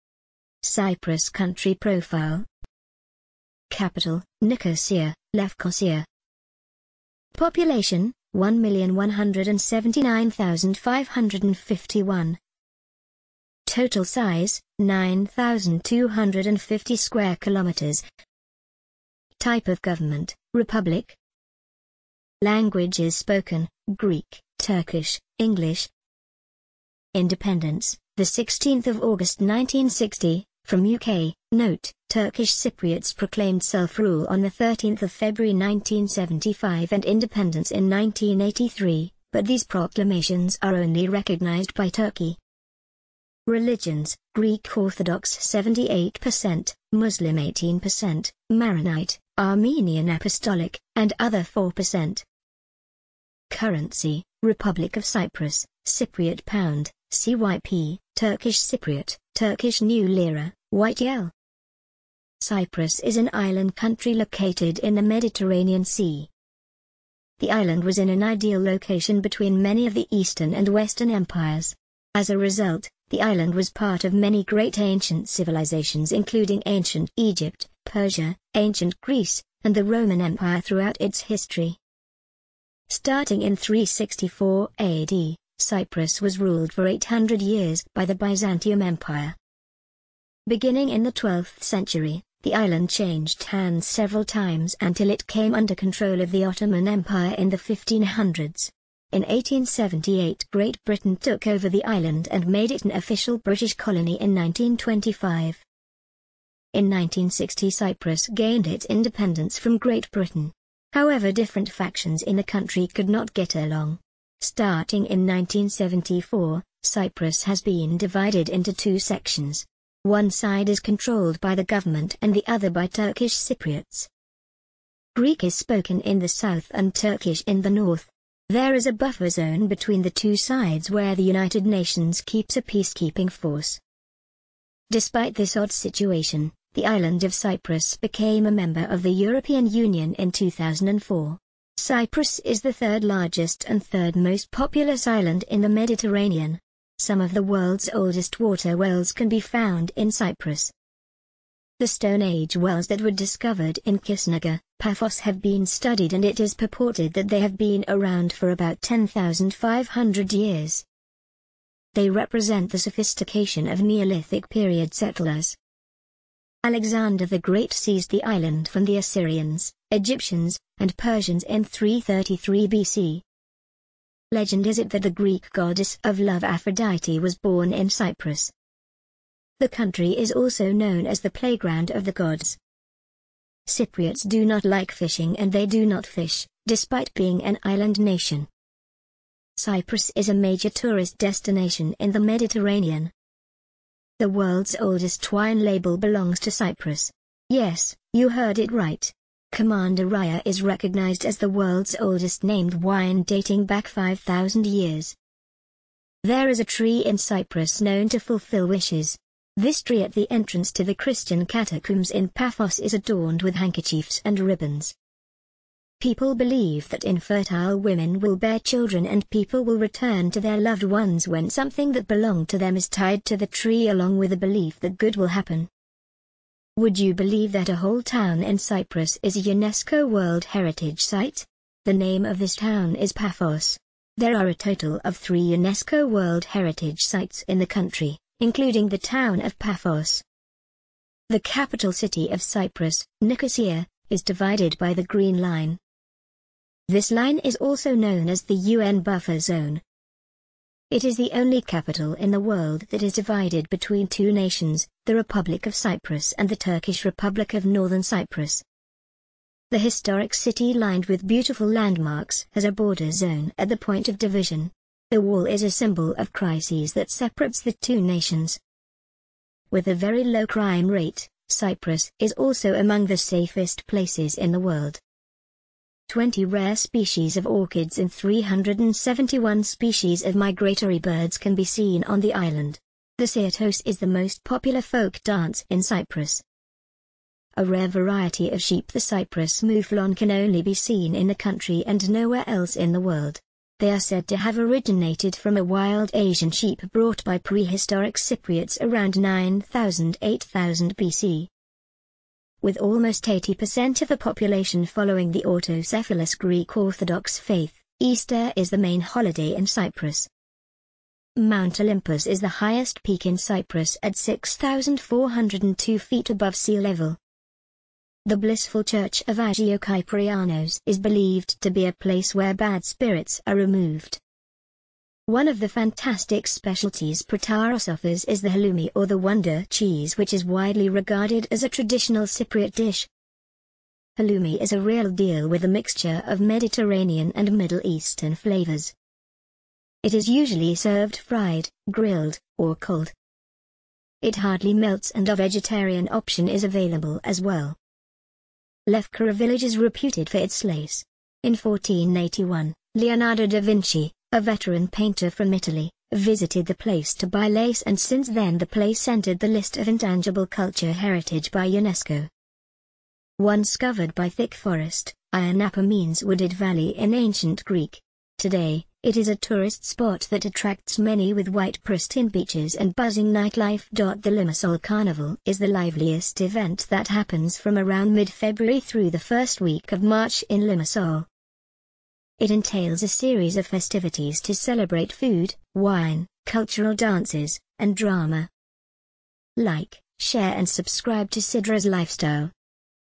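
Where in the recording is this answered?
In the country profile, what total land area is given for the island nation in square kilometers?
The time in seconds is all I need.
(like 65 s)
14 s.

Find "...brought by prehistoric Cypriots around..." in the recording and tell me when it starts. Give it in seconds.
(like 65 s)
296 s.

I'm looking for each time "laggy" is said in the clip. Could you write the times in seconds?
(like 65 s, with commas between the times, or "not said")
not said.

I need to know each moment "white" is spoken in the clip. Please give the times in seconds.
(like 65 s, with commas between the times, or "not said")
60 s, 371 s.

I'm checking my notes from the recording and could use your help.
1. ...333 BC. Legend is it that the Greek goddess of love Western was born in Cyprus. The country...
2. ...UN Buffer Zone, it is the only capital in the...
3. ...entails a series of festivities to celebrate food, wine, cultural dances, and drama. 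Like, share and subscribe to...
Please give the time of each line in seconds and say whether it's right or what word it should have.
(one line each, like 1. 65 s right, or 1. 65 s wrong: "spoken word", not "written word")
1. 171 s wrong: "Aphrodite", not "Western"
2. 248 s right
3. 382 s right.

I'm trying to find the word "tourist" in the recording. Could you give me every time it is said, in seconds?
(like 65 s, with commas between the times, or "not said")
190 s, 369 s.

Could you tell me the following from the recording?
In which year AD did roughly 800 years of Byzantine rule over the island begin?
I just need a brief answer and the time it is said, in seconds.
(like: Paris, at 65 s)
364, at 83 s.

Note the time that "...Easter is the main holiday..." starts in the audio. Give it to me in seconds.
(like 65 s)
307 s.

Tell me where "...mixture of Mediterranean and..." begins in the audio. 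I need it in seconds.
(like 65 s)
335 s.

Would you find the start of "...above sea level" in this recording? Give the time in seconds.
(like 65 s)
316 s.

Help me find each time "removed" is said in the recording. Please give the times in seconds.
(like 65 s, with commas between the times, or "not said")
323 s.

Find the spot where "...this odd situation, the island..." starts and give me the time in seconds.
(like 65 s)
135 s.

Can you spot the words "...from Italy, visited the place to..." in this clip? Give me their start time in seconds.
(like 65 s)
355 s.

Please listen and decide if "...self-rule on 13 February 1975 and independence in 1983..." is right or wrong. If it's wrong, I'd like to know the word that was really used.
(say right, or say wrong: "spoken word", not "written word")
right.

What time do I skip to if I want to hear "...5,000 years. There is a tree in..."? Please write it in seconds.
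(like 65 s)
203 s.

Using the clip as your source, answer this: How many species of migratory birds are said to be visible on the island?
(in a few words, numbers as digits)
371.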